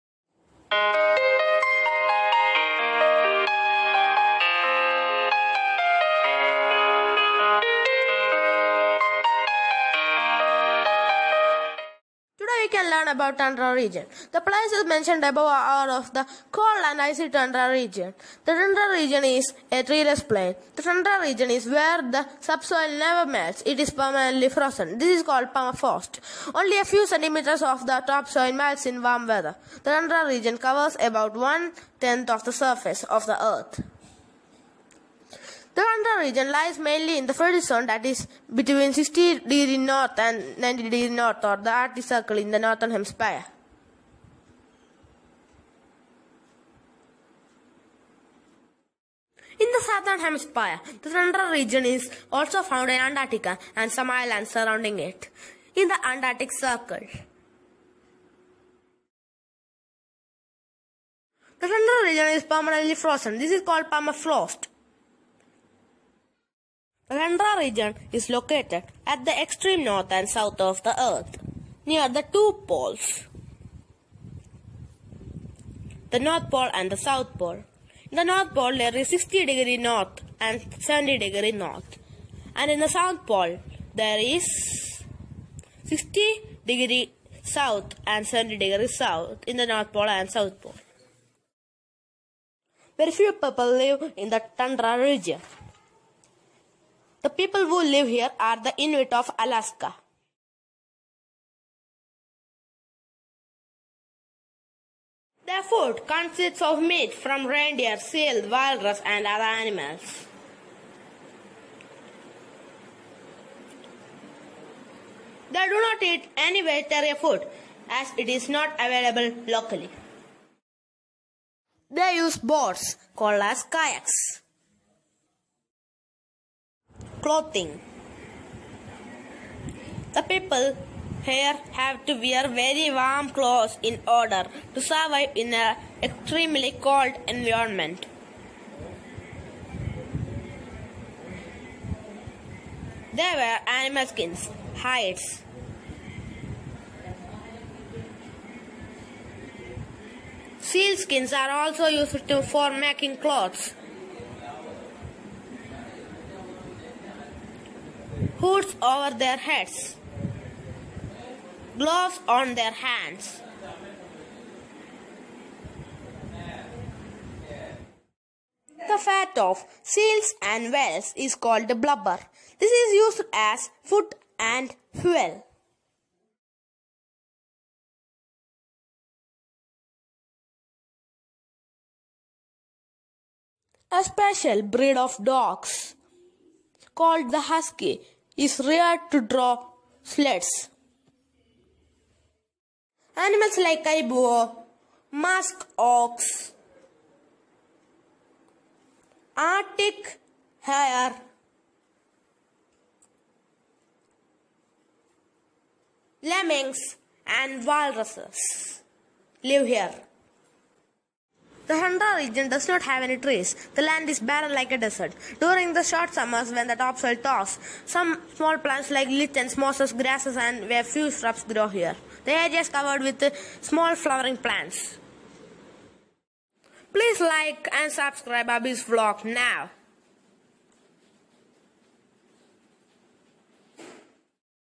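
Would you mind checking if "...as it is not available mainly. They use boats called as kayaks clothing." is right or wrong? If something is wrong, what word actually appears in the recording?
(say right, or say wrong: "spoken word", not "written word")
wrong: "locally", not "mainly".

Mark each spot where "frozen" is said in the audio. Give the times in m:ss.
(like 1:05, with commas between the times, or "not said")
0:24, 1:02.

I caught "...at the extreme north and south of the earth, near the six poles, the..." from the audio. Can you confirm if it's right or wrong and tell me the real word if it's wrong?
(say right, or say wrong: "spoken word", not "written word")
wrong: "two", not "six".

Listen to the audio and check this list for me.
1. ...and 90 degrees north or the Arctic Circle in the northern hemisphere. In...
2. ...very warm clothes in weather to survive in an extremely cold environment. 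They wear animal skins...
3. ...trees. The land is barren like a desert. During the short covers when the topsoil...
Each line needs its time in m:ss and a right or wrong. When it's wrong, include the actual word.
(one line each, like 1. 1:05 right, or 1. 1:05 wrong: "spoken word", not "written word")
1. 0:40 right
2. 2:12 wrong: "order", not "weather"
3. 3:33 wrong: "summers", not "covers".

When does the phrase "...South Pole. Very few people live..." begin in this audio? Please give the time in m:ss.
1:30.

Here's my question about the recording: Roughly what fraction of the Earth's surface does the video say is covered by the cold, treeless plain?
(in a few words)
one tenth.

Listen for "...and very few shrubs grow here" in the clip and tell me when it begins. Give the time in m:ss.
3:40.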